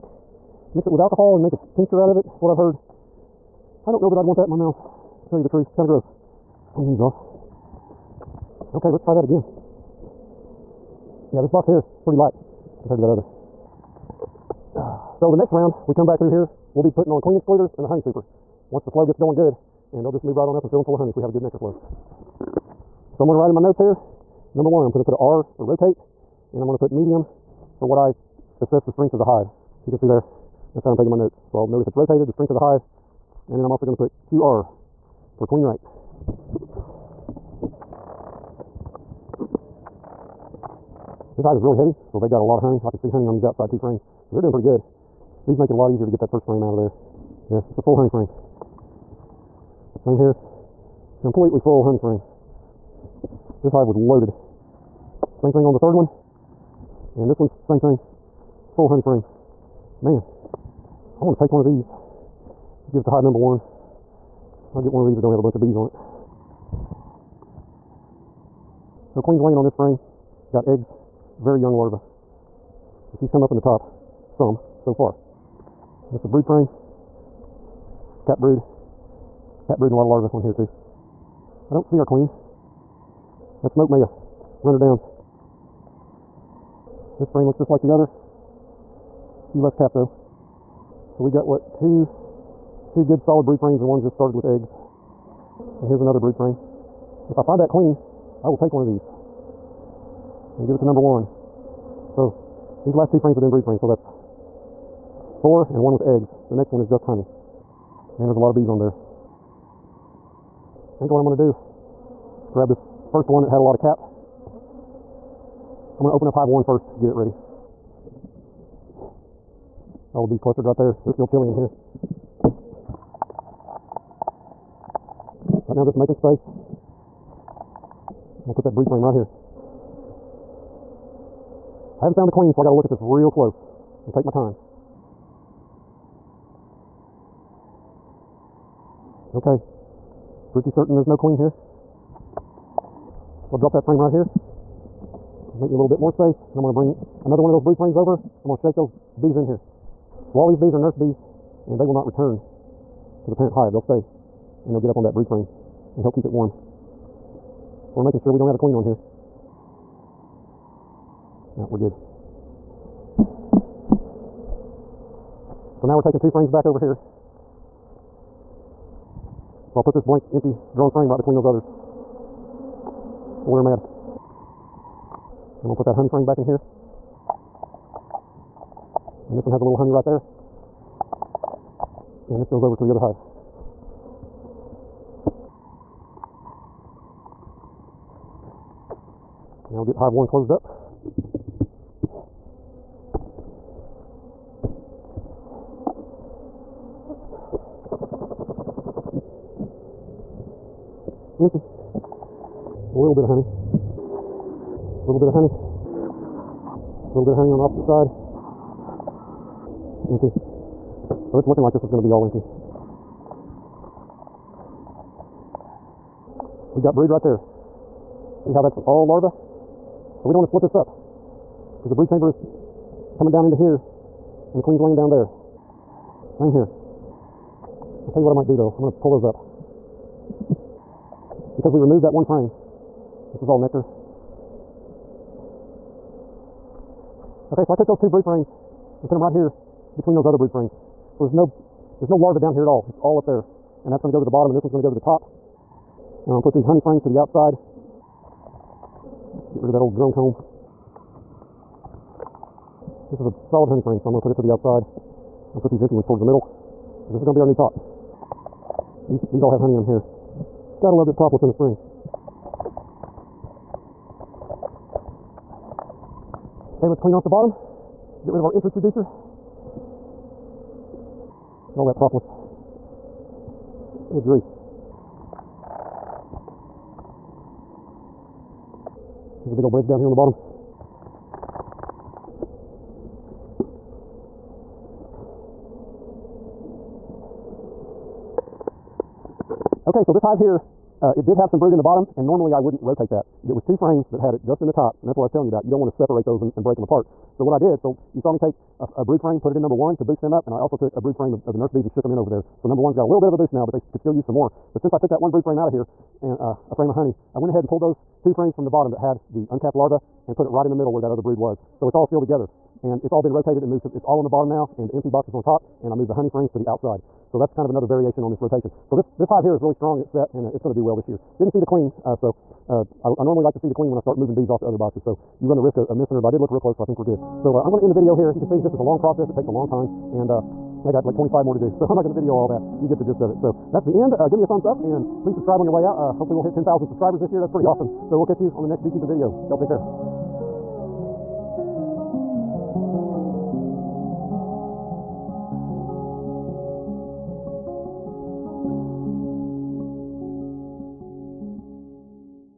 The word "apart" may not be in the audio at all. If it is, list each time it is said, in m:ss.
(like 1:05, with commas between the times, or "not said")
4:56.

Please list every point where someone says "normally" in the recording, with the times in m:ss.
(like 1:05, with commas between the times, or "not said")
4:52, 5:23.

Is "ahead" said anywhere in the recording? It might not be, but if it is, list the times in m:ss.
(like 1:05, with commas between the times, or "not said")
5:07.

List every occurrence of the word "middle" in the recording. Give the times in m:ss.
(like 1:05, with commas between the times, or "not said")
4:16, 5:10.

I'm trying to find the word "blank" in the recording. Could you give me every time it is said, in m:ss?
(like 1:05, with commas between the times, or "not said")
2:50.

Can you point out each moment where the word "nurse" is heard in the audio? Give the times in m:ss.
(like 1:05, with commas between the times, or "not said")
2:30, 5:01.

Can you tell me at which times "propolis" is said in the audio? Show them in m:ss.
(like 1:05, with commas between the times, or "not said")
4:21, 4:31.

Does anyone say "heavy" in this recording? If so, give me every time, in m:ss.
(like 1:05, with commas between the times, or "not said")
0:41.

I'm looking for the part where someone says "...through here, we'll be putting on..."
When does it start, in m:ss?
0:16.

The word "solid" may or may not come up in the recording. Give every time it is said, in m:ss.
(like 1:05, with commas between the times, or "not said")
1:33, 4:13.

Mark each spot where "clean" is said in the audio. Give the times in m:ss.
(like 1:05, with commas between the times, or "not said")
0:06, 4:26.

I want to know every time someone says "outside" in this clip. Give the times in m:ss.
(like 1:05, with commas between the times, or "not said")
0:43, 4:07, 4:14, 5:16.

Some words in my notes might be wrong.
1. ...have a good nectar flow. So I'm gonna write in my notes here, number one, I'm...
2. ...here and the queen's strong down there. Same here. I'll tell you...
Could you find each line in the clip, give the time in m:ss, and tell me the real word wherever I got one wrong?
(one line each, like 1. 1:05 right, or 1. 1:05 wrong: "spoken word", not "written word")
1. 0:21 right
2. 3:43 wrong: "laying", not "strong".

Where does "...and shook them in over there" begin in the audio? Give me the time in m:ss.
5:01.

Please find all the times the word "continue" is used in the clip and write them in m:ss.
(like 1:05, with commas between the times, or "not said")
not said.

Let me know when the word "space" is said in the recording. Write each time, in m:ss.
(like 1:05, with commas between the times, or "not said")
2:06, 2:26.